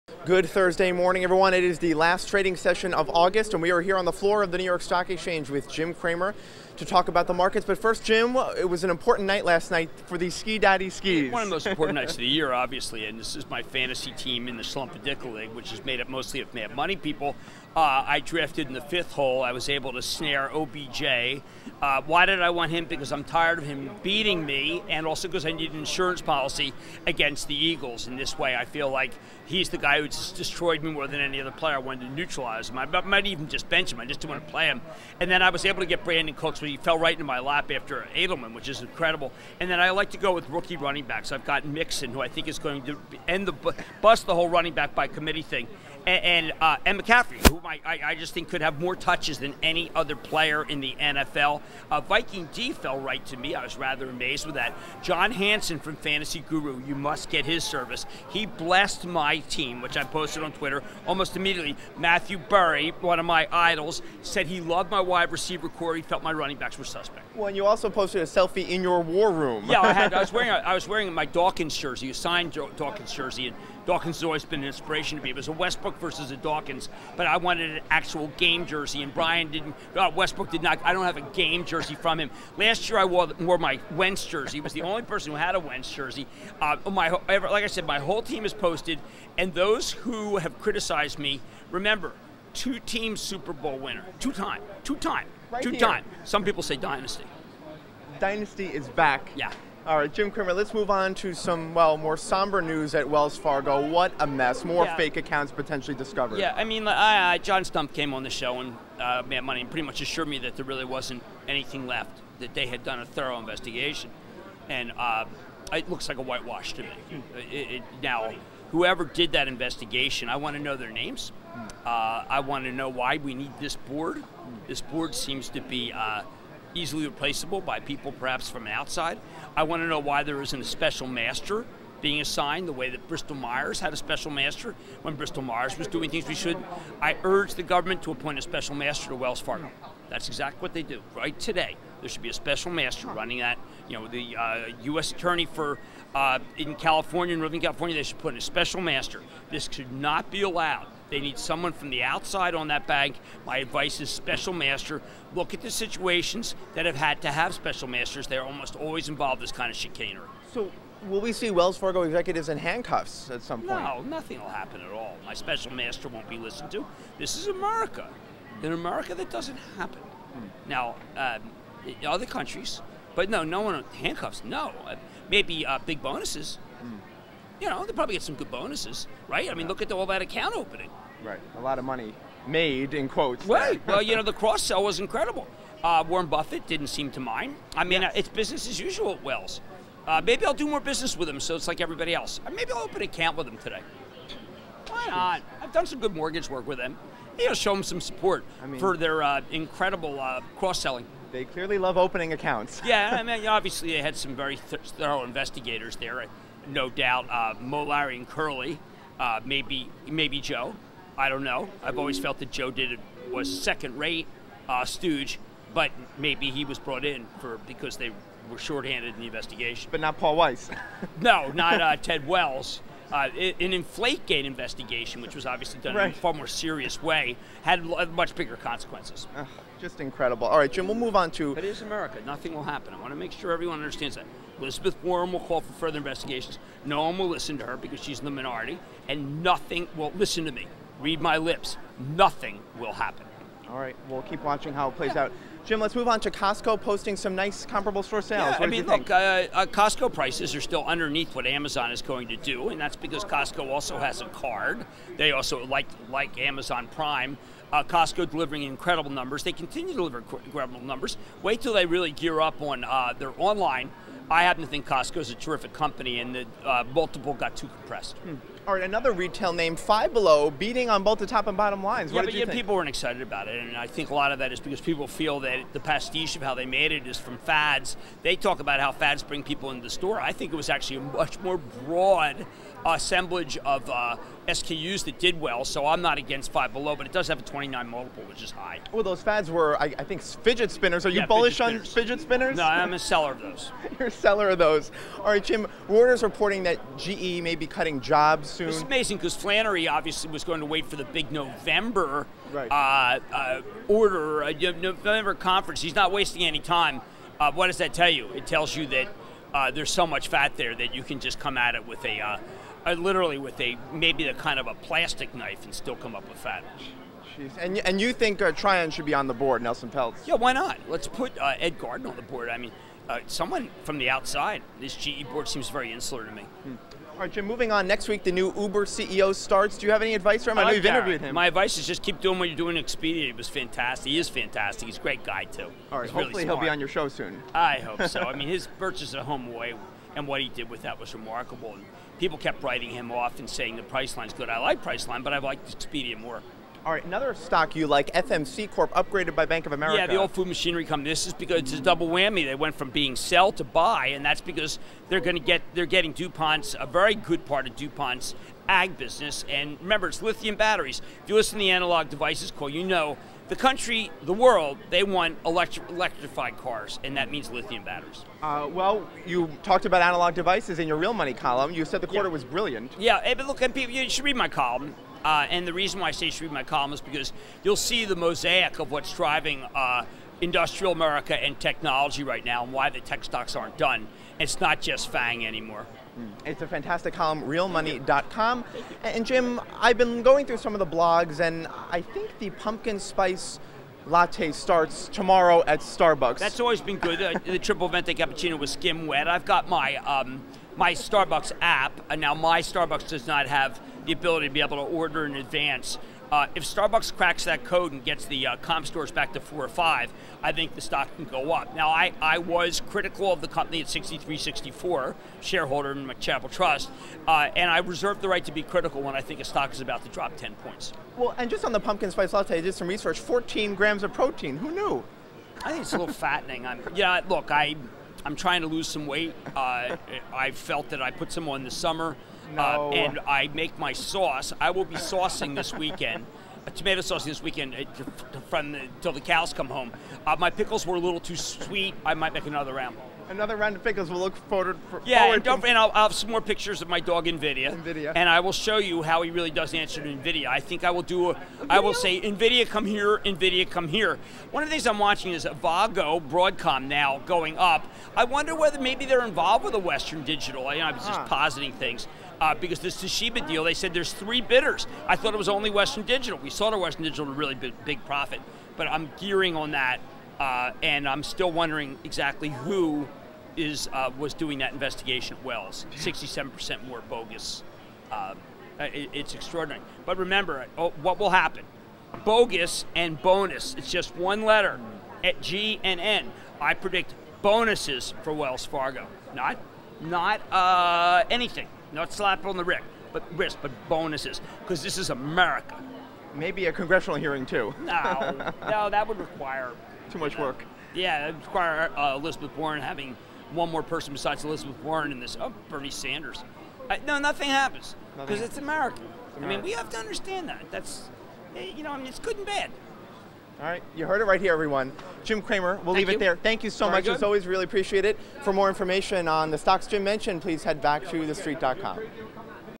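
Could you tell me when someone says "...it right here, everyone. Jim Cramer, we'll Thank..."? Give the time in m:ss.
8:34.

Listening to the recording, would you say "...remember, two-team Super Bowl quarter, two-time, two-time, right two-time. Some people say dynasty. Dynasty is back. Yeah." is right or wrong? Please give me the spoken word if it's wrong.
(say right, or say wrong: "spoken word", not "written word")
wrong: "winner", not "quarter".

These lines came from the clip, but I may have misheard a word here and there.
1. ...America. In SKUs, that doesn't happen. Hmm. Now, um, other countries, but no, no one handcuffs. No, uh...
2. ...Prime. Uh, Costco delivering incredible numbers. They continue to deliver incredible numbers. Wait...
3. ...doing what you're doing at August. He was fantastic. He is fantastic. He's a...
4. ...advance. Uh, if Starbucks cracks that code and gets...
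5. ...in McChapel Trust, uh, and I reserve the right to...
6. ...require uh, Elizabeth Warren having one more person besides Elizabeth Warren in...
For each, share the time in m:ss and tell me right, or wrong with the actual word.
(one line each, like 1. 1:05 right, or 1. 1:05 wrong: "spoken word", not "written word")
1. 2:47 wrong: "America", not "SKUs"
2. 4:16 right
3. 5:32 wrong: "Expedia", not "August"
4. 6:45 right
5. 6:55 right
6. 8:21 right.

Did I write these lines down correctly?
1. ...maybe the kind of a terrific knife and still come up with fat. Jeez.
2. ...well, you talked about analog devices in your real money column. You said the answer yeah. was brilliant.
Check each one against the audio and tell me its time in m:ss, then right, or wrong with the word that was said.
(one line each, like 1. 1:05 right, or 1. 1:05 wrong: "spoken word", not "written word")
1. 5:13 wrong: "plastic", not "terrific"
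2. 6:08 wrong: "quarter", not "answer".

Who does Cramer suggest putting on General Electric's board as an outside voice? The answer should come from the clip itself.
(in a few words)
Ed Garden.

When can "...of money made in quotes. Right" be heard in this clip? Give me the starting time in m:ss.
3:01.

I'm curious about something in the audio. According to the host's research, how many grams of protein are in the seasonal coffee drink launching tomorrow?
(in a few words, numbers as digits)
14.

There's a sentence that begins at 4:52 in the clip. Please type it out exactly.
No, I'm a seller of those.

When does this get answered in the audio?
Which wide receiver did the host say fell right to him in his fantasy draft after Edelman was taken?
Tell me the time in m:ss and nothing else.
0:36.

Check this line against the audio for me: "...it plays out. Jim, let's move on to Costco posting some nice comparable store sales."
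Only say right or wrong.
right.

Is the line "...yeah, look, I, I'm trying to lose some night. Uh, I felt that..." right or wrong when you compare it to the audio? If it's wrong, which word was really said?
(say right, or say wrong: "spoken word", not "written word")
wrong: "weight", not "night".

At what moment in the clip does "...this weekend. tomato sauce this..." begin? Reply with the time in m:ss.
7:15.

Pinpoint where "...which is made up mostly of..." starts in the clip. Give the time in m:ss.
0:15.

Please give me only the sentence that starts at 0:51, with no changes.
Uh, Viking D fell right to me.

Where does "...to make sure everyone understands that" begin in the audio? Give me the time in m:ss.
3:53.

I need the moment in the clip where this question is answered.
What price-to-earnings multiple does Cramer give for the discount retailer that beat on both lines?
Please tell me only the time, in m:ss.
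4:47.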